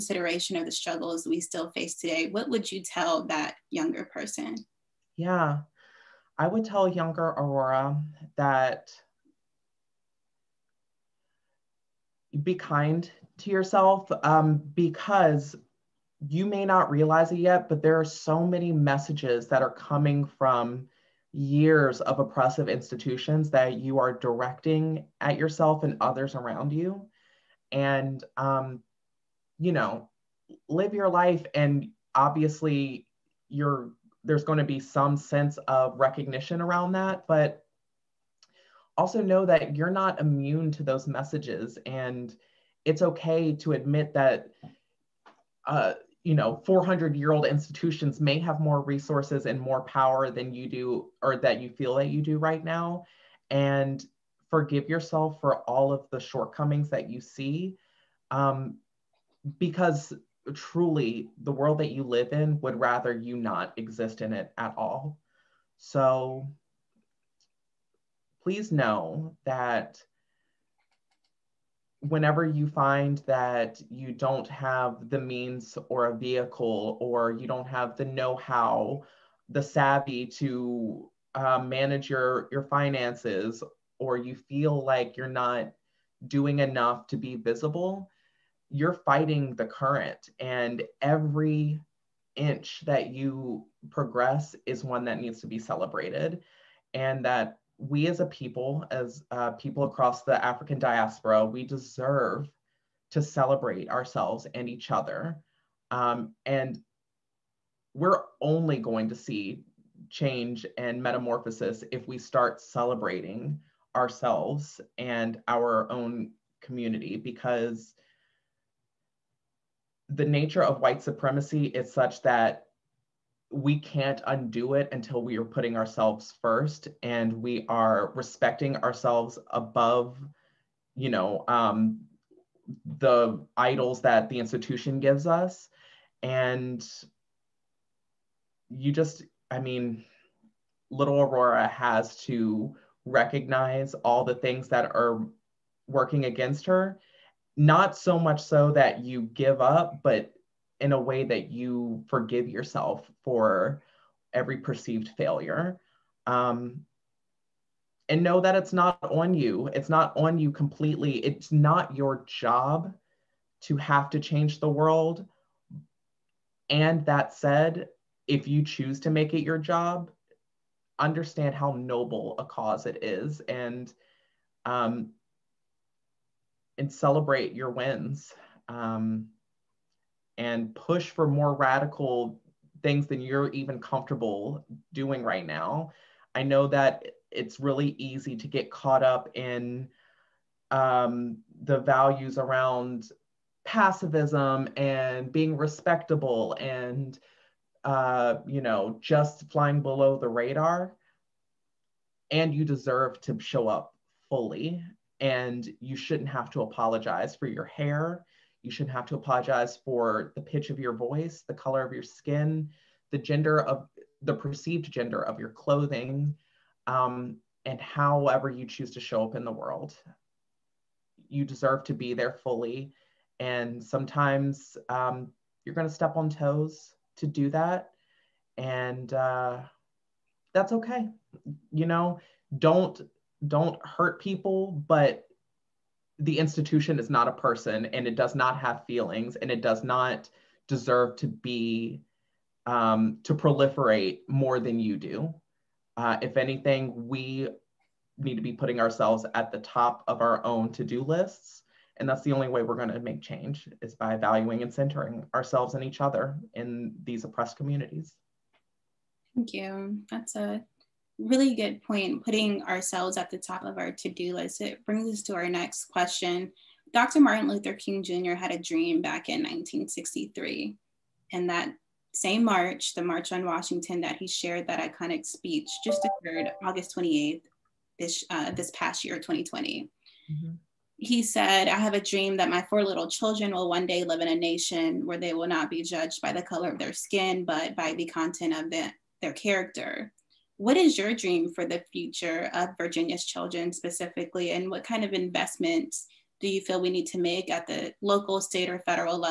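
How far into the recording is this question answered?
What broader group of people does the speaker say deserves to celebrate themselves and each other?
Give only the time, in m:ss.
1:40.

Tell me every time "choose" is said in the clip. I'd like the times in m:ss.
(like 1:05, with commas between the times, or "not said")
2:48, 3:38.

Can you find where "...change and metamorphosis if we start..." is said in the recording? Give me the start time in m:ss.
1:50.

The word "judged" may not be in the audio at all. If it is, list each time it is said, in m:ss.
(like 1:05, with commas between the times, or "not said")
4:45.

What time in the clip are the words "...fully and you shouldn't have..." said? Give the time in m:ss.
3:24.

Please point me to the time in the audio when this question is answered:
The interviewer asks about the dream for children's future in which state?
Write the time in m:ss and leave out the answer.
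4:52.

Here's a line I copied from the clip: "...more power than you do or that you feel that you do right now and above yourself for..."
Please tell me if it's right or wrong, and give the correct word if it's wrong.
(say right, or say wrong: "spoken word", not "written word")
wrong: "forgive", not "above".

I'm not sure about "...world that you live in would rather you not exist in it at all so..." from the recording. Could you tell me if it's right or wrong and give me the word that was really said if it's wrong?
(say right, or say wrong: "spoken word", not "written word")
right.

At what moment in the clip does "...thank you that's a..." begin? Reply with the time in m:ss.
4:19.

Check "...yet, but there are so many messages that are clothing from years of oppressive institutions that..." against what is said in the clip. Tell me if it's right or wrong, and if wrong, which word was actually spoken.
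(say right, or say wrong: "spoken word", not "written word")
wrong: "coming", not "clothing".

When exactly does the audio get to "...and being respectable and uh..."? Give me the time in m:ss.
3:14.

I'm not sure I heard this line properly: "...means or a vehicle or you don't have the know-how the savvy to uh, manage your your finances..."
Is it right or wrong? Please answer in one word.
right.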